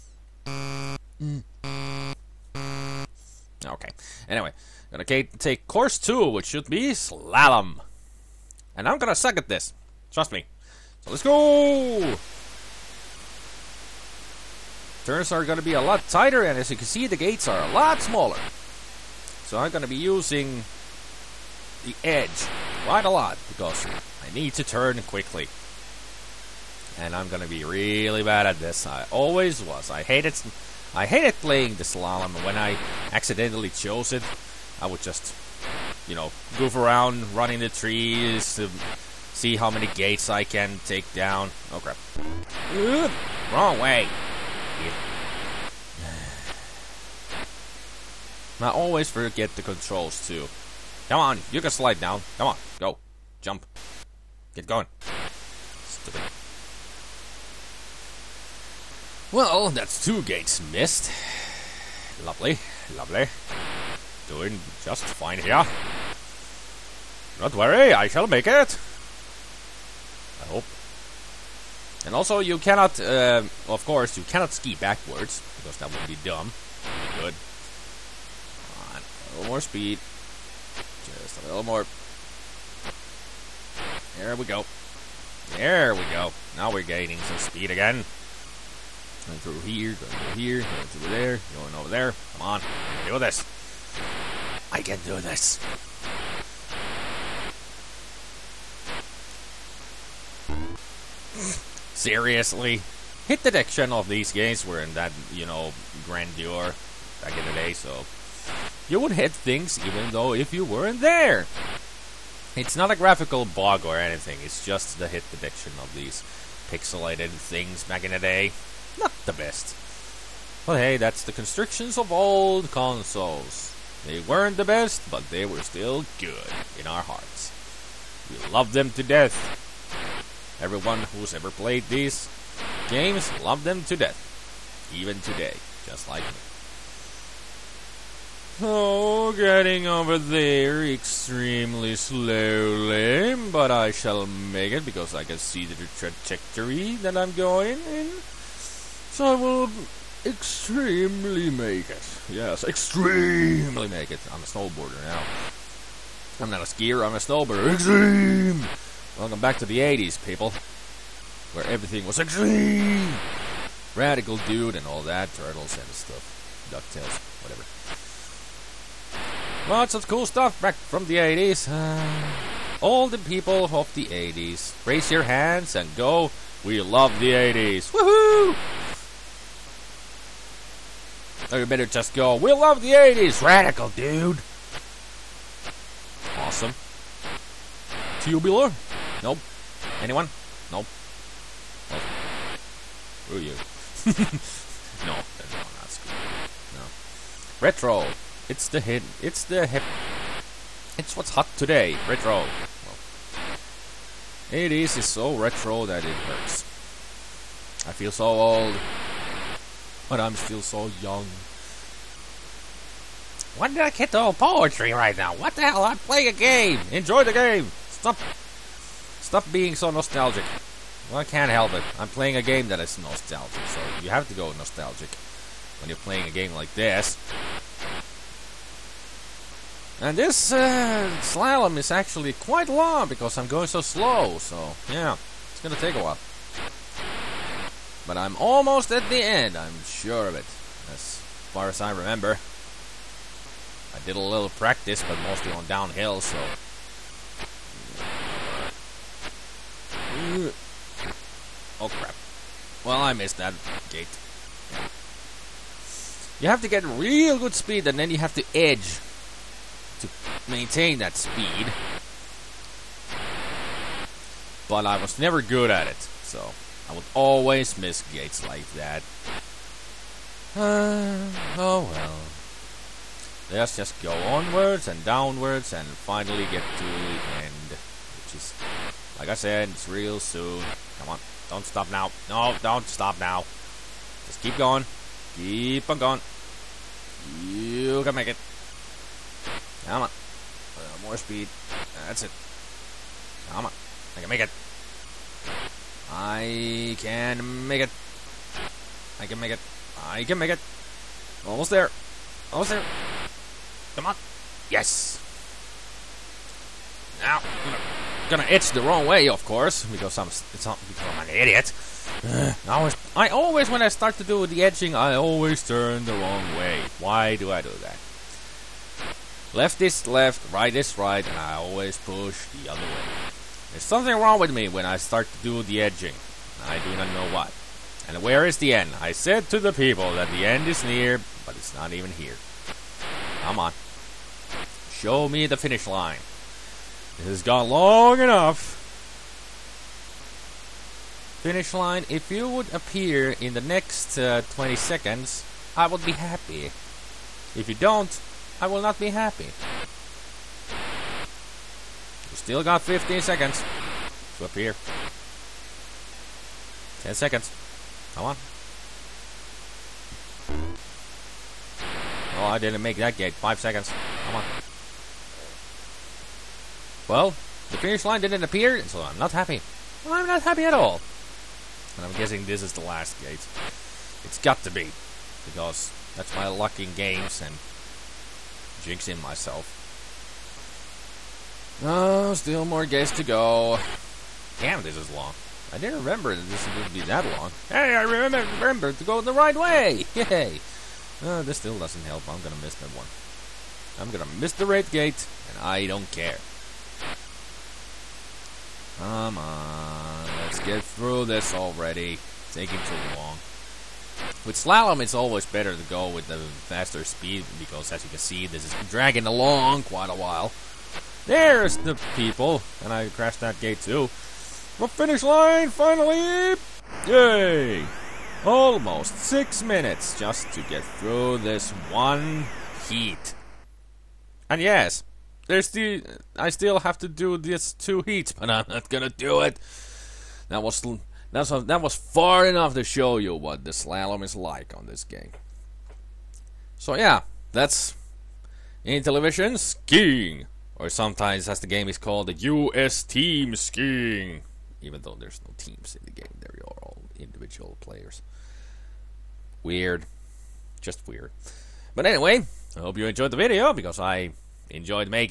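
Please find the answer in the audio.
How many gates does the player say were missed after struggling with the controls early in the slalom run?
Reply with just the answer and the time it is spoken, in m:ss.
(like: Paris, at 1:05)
2, at 1:00.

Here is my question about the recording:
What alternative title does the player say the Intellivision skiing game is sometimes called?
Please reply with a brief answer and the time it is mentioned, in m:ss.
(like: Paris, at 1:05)
U.S. team skiing, at 7:22.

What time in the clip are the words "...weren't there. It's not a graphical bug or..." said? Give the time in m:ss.
1:50.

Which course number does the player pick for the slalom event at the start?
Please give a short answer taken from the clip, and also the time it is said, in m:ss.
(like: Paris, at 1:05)
2, at 0:05.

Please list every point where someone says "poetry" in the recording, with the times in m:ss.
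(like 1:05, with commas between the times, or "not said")
3:34.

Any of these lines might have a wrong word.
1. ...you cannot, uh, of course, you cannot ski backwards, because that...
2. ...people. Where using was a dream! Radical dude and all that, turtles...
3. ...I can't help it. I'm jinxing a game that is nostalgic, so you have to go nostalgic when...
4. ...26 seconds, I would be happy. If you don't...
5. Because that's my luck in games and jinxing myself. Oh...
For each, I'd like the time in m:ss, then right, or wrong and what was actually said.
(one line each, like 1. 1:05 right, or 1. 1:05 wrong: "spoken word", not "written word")
1. 1:12 right
2. 2:40 wrong: "everything", not "using"
3. 3:41 wrong: "playing", not "jinxing"
4. 5:44 wrong: "20", not "26"
5. 6:15 right.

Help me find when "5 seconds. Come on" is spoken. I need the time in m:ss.
6:03.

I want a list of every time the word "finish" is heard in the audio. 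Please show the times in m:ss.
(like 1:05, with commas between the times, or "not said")
5:35, 5:41, 6:07, 6:54.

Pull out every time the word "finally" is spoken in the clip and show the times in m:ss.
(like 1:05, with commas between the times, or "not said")
4:35, 6:55.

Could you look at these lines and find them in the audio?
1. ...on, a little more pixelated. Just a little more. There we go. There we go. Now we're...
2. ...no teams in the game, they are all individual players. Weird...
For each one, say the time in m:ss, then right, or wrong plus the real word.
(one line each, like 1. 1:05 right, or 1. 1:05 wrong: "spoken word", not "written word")
1. 1:18 wrong: "speed", not "pixelated"
2. 7:25 right.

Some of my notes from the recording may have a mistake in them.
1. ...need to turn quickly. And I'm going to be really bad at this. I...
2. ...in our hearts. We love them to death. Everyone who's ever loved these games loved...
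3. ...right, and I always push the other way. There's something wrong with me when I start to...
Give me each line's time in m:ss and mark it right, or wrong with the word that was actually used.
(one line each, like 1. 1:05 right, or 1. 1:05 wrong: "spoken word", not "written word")
1. 0:24 right
2. 2:06 wrong: "played", not "loved"
3. 5:20 right.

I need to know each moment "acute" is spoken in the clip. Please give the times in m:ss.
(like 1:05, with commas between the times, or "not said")
not said.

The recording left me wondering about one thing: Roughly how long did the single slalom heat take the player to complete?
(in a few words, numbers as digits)
Almost 6 minutes.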